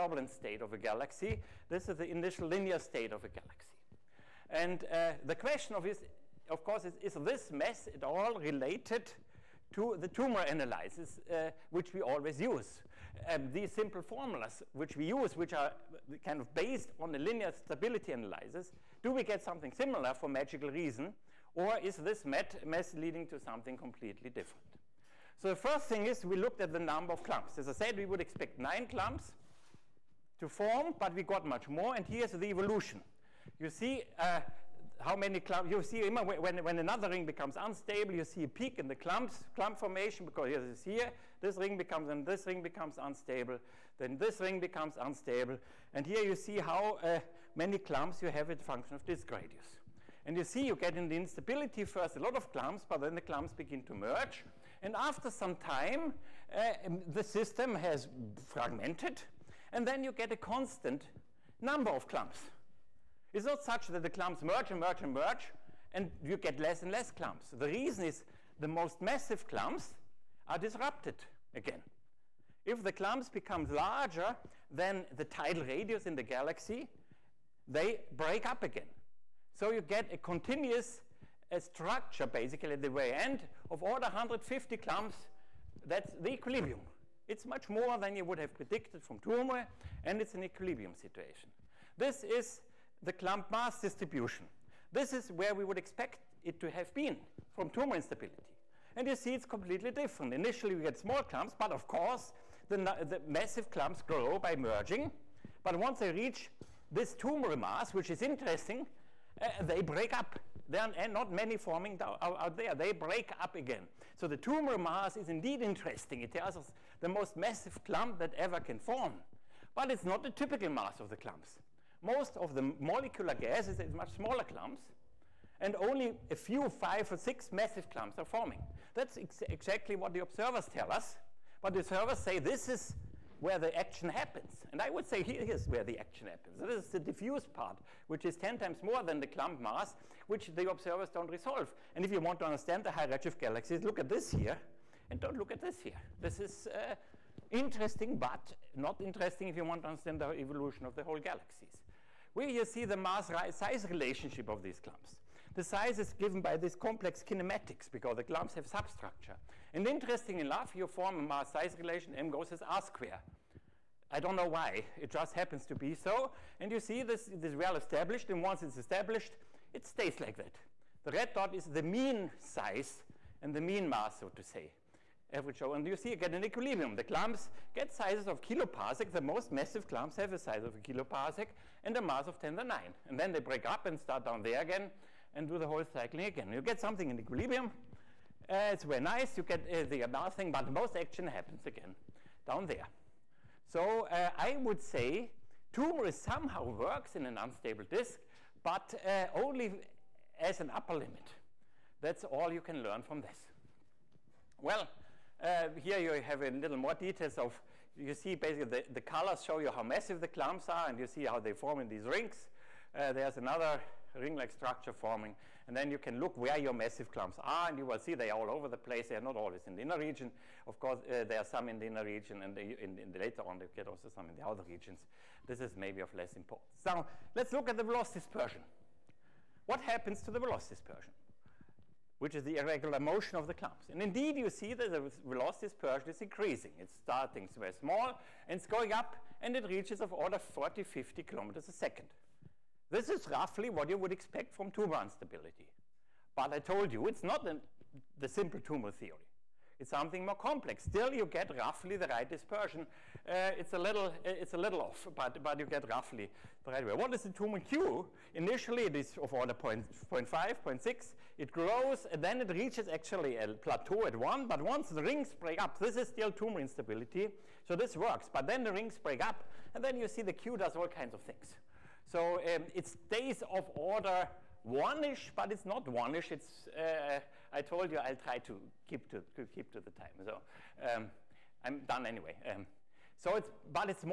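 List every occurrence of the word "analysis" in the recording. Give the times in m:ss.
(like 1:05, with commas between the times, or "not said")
0:10, 0:18.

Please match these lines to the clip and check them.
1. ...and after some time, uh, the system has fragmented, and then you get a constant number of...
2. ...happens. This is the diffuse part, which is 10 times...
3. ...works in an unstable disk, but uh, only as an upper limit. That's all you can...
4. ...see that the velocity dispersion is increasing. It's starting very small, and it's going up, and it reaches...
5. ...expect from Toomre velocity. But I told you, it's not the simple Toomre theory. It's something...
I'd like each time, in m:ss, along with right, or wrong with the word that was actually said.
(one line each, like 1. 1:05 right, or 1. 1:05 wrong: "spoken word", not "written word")
1. 0:54 right
2. 2:16 right
3. 3:16 right
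4. 3:54 right
5. 4:04 wrong: "instability", not "velocity".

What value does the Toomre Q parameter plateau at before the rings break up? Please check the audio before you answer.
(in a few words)
1.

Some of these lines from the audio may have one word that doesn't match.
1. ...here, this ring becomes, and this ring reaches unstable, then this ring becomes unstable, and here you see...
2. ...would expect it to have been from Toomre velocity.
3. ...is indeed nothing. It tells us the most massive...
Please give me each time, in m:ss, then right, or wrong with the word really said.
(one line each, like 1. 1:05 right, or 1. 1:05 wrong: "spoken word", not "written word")
1. 0:40 wrong: "becomes", not "reaches"
2. 1:35 wrong: "instability", not "velocity"
3. 1:55 wrong: "interesting", not "nothing".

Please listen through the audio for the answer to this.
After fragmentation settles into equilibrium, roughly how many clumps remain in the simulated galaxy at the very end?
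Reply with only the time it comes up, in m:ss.
1:24.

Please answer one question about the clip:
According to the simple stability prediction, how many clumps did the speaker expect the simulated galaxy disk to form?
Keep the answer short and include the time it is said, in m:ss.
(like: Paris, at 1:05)
9, at 0:28.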